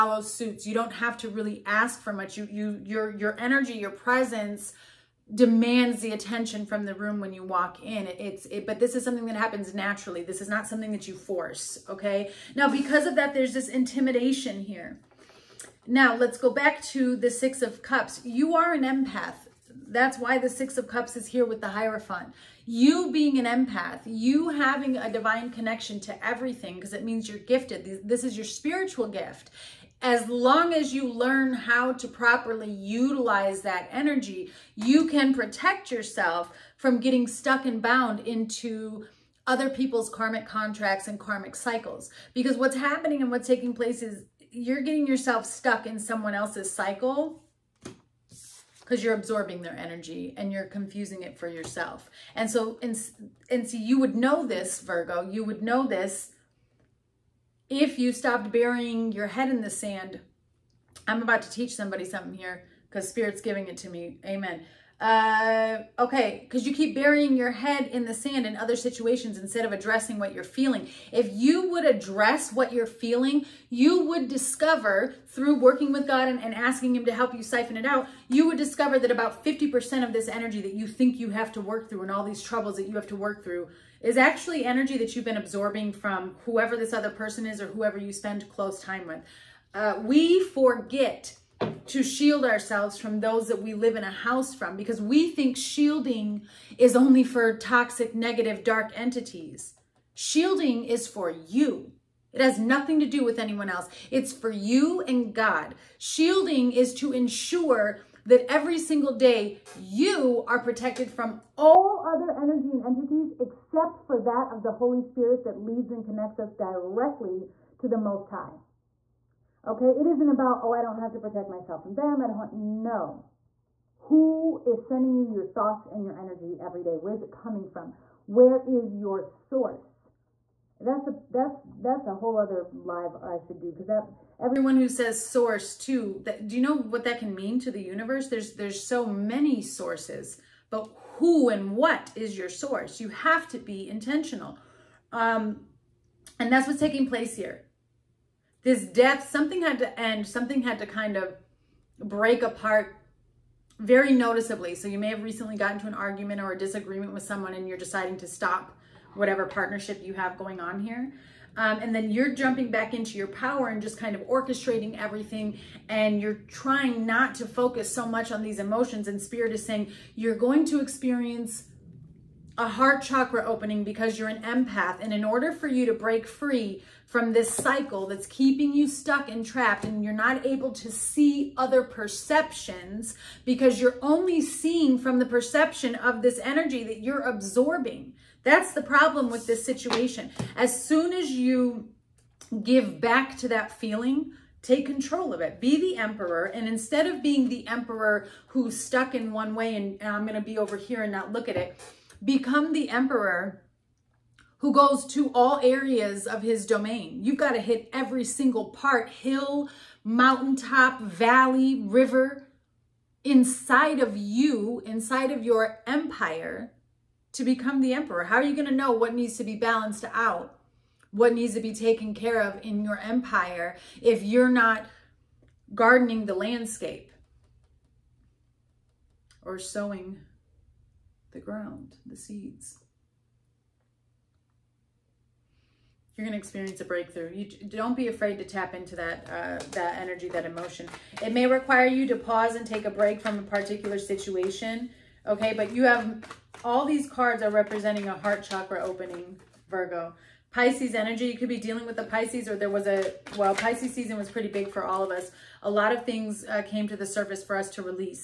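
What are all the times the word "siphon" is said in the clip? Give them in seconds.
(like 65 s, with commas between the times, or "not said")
77 s.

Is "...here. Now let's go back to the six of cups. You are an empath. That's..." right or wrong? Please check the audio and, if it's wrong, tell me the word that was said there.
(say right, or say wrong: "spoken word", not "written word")
right.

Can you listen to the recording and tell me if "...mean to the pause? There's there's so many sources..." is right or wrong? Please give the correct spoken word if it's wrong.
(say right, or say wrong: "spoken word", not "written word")
wrong: "universe", not "pause".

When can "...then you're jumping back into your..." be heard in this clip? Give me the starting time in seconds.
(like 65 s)
161 s.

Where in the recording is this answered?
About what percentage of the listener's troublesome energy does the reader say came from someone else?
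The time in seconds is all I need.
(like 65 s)
79 s.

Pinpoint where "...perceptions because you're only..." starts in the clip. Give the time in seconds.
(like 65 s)
181 s.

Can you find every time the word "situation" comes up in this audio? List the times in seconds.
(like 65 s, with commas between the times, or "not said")
68 s, 189 s, 243 s.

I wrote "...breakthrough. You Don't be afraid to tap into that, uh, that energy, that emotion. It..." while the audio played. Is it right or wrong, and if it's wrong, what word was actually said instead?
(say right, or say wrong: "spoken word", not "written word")
right.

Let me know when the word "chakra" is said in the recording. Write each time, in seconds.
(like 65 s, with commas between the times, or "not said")
173 s, 248 s.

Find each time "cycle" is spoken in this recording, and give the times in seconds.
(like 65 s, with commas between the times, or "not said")
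41 s, 46 s, 177 s.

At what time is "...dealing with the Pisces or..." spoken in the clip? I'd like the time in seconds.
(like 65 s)
251 s.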